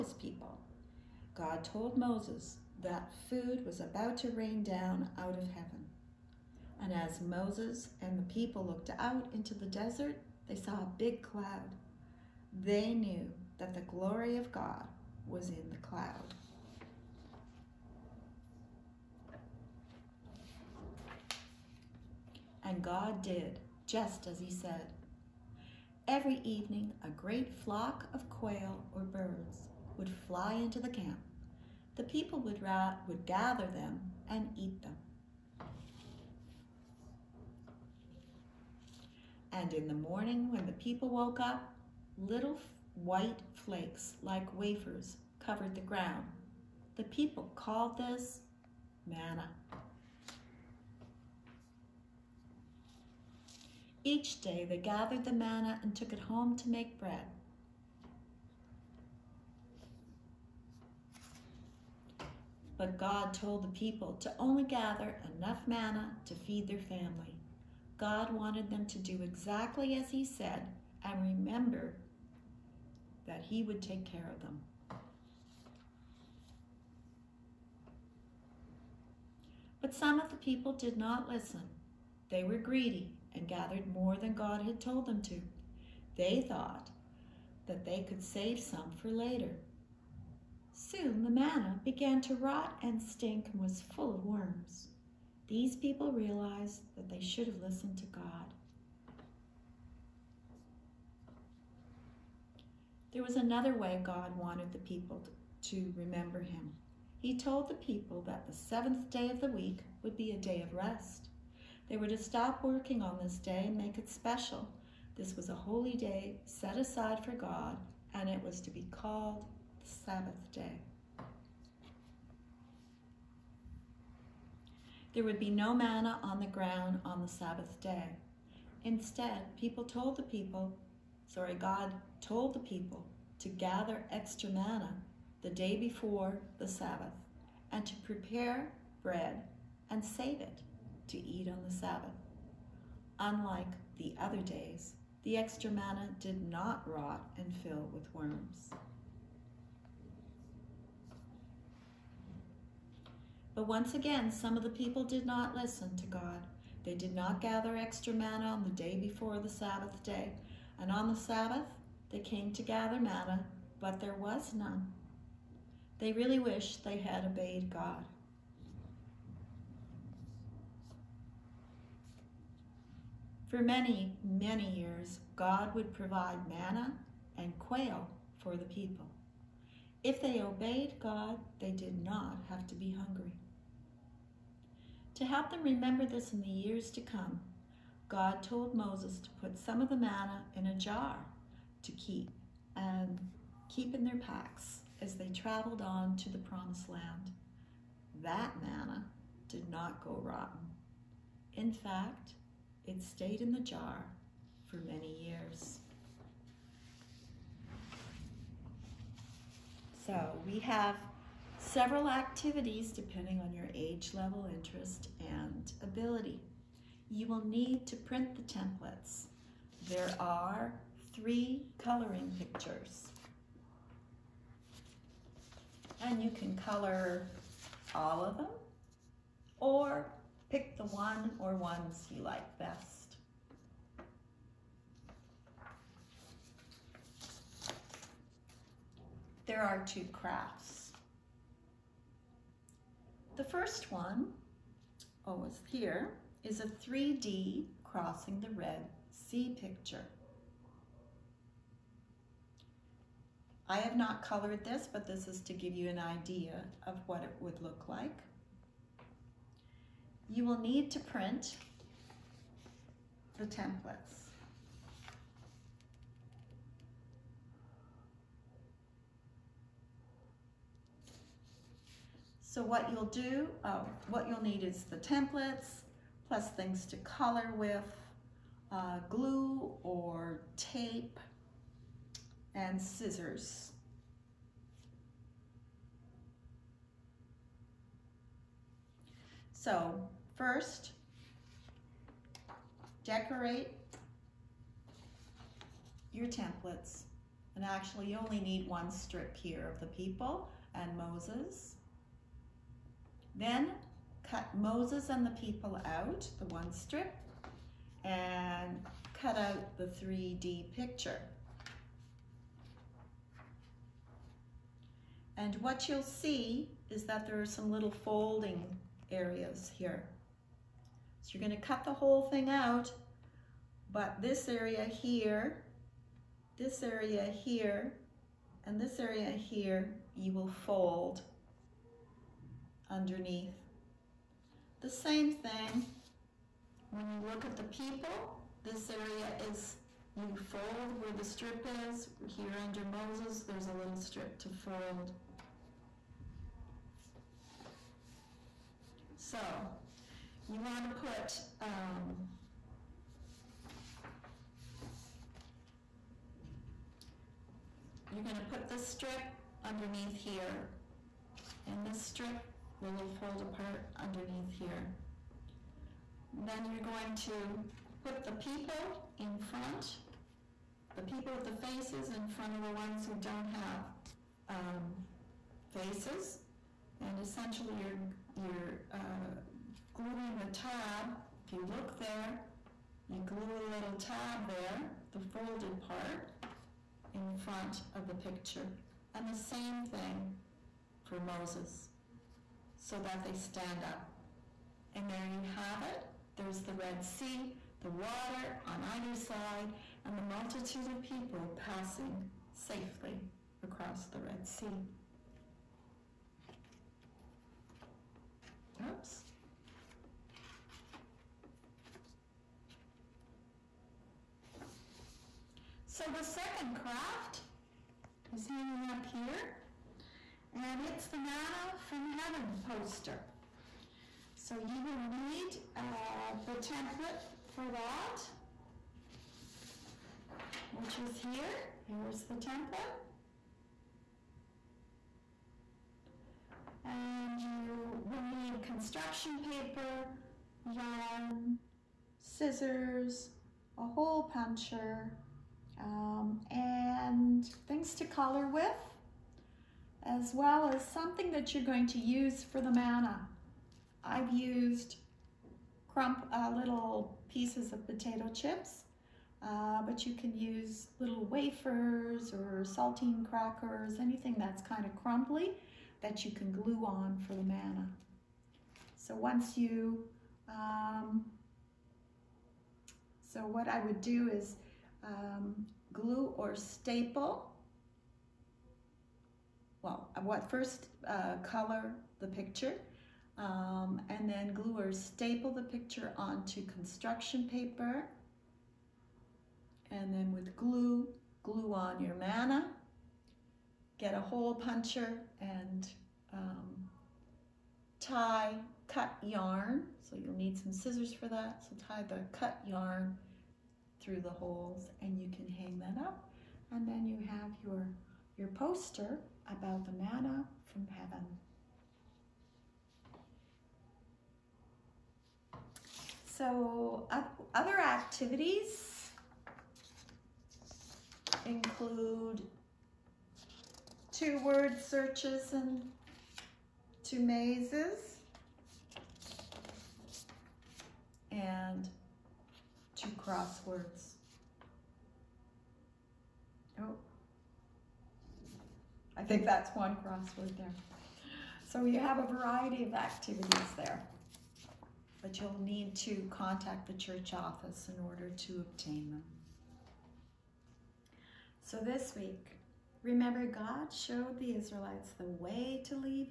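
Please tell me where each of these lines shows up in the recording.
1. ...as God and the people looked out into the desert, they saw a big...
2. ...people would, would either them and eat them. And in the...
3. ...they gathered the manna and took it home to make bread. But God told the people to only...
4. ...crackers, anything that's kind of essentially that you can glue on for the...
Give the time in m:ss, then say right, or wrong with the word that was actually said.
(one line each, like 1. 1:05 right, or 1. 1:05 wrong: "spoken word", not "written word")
1. 0:06 wrong: "Moses", not "God"
2. 0:32 wrong: "gather", not "either"
3. 0:54 right
4. 7:43 wrong: "crumbly", not "essentially".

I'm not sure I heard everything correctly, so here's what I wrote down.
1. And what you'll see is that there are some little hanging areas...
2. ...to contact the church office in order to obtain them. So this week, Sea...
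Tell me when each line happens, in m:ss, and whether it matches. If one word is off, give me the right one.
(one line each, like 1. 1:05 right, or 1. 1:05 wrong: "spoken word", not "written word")
1. 5:15 wrong: "folding", not "hanging"
2. 9:05 wrong: "Remember", not "Sea".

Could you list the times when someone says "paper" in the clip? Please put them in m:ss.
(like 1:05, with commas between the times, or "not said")
7:19, 8:07.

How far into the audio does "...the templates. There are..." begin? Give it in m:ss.
3:38.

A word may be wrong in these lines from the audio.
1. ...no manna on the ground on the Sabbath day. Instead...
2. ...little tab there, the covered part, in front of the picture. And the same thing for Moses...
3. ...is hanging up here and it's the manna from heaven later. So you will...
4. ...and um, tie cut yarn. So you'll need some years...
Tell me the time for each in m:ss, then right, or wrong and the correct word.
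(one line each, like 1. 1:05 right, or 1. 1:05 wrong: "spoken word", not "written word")
1. 2:05 right
2. 6:23 wrong: "folded", not "covered"
3. 6:58 wrong: "poster", not "later"
4. 8:15 wrong: "scissors", not "years".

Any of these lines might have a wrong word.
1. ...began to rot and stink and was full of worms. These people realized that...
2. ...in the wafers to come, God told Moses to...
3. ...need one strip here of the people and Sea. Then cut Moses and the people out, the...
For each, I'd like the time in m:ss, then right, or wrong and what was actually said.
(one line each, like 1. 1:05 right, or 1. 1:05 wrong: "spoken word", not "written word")
1. 1:31 right
2. 3:06 wrong: "years", not "wafers"
3. 4:58 wrong: "Moses", not "Sea".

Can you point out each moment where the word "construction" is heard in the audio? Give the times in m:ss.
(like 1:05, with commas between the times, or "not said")
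7:18, 8:06.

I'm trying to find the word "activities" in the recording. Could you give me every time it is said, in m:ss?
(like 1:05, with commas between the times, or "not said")
3:32, 8:37, 9:02.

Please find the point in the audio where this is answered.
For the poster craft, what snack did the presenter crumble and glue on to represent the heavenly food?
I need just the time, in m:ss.
7:37.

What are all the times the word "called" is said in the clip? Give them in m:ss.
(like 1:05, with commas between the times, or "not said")
0:47, 1:58.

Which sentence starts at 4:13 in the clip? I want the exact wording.
I have not colored this, but this is to give you an idea of what it would look like.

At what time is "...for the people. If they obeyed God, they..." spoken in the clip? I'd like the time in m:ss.
2:58.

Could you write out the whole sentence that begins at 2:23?
Unlike the other days, the extra manna did not rot and fill with worms.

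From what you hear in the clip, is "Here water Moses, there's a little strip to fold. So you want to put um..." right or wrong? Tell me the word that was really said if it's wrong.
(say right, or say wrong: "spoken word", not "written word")
wrong: "under", not "water".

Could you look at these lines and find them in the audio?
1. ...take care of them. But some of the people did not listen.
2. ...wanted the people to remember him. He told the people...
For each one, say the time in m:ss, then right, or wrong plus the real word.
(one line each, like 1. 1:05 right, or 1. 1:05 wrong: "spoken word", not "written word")
1. 1:13 right
2. 1:44 right.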